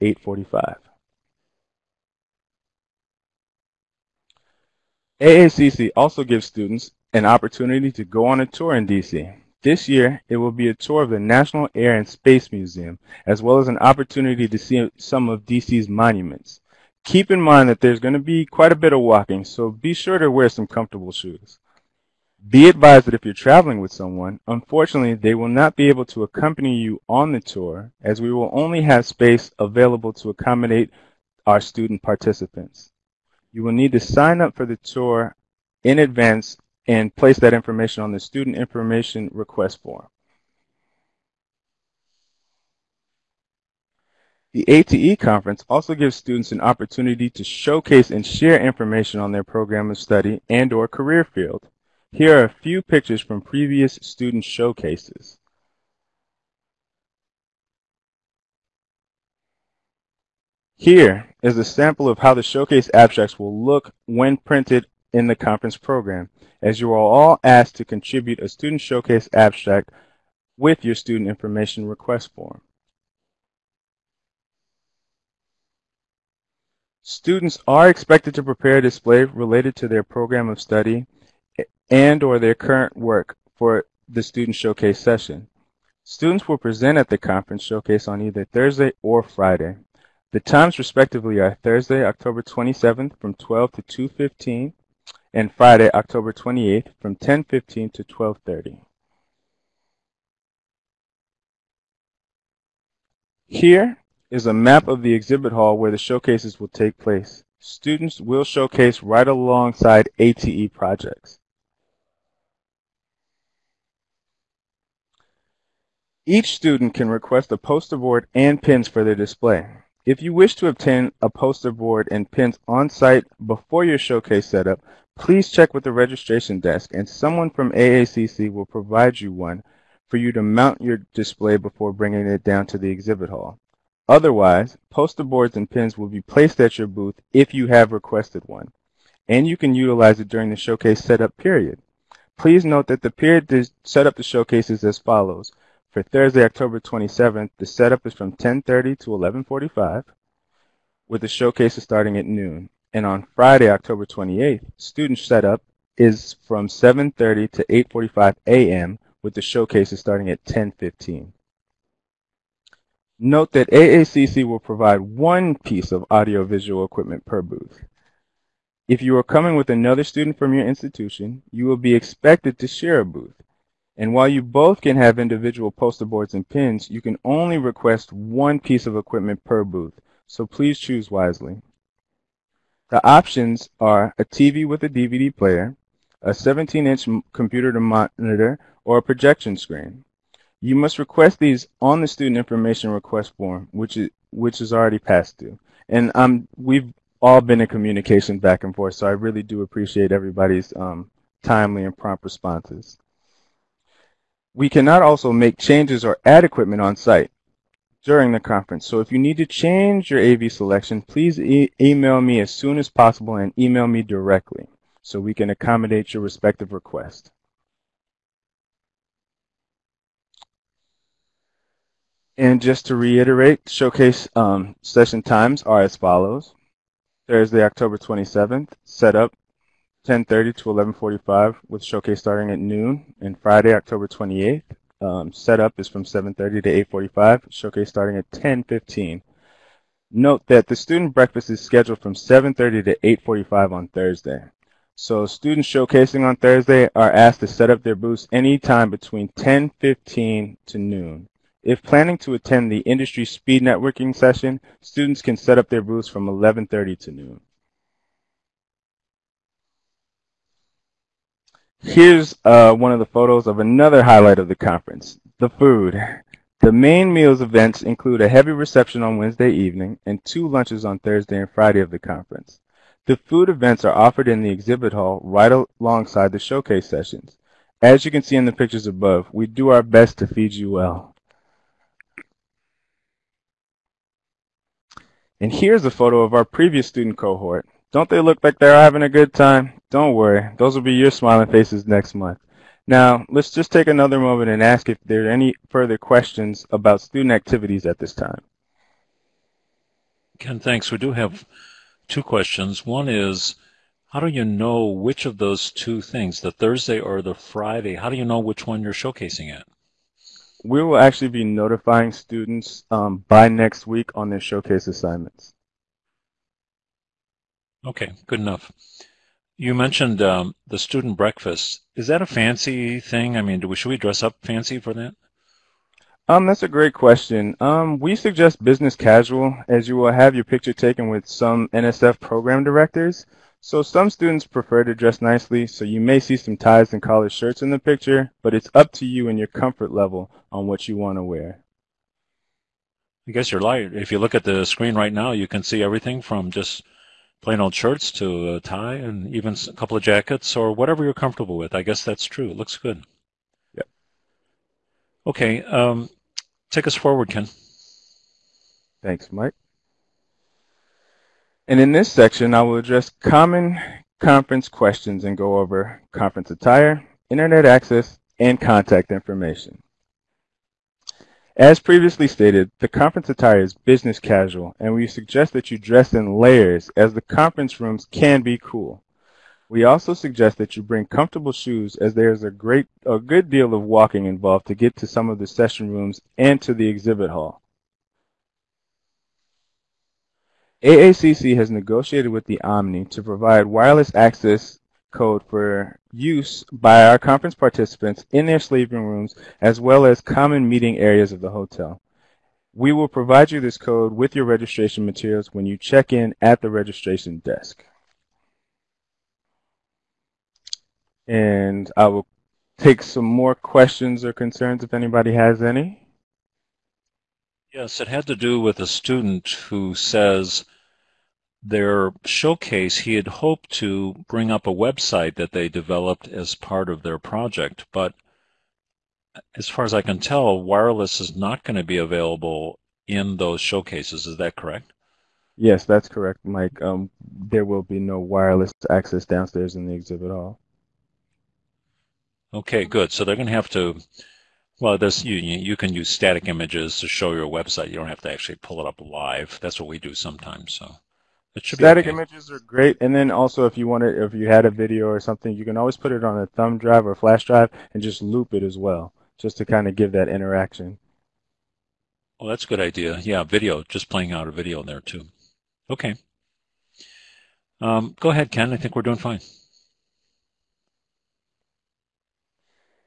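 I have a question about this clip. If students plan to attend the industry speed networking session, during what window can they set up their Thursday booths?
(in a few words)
11:30 to noon.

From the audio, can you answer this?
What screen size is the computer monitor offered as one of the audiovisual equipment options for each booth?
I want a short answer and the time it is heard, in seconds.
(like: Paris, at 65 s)
17-inch, at 186 s.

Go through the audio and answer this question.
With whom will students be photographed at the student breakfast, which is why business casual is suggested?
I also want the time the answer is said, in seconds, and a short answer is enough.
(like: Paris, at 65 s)
NSF program directors, at 331 s.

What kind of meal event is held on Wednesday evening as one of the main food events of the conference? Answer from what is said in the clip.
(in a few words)
heavy reception.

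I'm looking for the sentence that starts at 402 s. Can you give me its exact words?
We will provide you this code with your registration materials when you check in at the registration desk.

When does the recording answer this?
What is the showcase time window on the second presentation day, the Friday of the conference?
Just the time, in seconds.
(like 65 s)
97 s.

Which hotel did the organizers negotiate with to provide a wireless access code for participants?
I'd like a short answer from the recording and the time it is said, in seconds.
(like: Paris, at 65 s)
Omni, at 392 s.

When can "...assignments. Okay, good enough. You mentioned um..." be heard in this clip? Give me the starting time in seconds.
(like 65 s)
314 s.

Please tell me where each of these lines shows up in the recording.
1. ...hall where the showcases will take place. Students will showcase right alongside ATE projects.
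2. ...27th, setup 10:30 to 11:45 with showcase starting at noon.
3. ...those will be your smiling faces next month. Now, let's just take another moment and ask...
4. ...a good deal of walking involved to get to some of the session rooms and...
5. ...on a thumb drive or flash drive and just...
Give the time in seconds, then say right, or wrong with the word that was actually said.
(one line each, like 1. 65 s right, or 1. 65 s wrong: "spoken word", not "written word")
1. 105 s right
2. 227 s right
3. 290 s right
4. 383 s right
5. 456 s right.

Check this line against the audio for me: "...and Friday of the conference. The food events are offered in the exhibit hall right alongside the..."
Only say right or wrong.
right.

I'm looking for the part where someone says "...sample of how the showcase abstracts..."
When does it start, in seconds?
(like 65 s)
61 s.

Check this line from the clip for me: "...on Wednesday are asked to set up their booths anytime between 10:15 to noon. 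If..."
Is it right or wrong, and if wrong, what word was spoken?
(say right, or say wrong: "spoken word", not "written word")
wrong: "Thursday", not "Wednesday".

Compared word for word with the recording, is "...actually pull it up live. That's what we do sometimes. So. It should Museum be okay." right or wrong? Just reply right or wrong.
wrong.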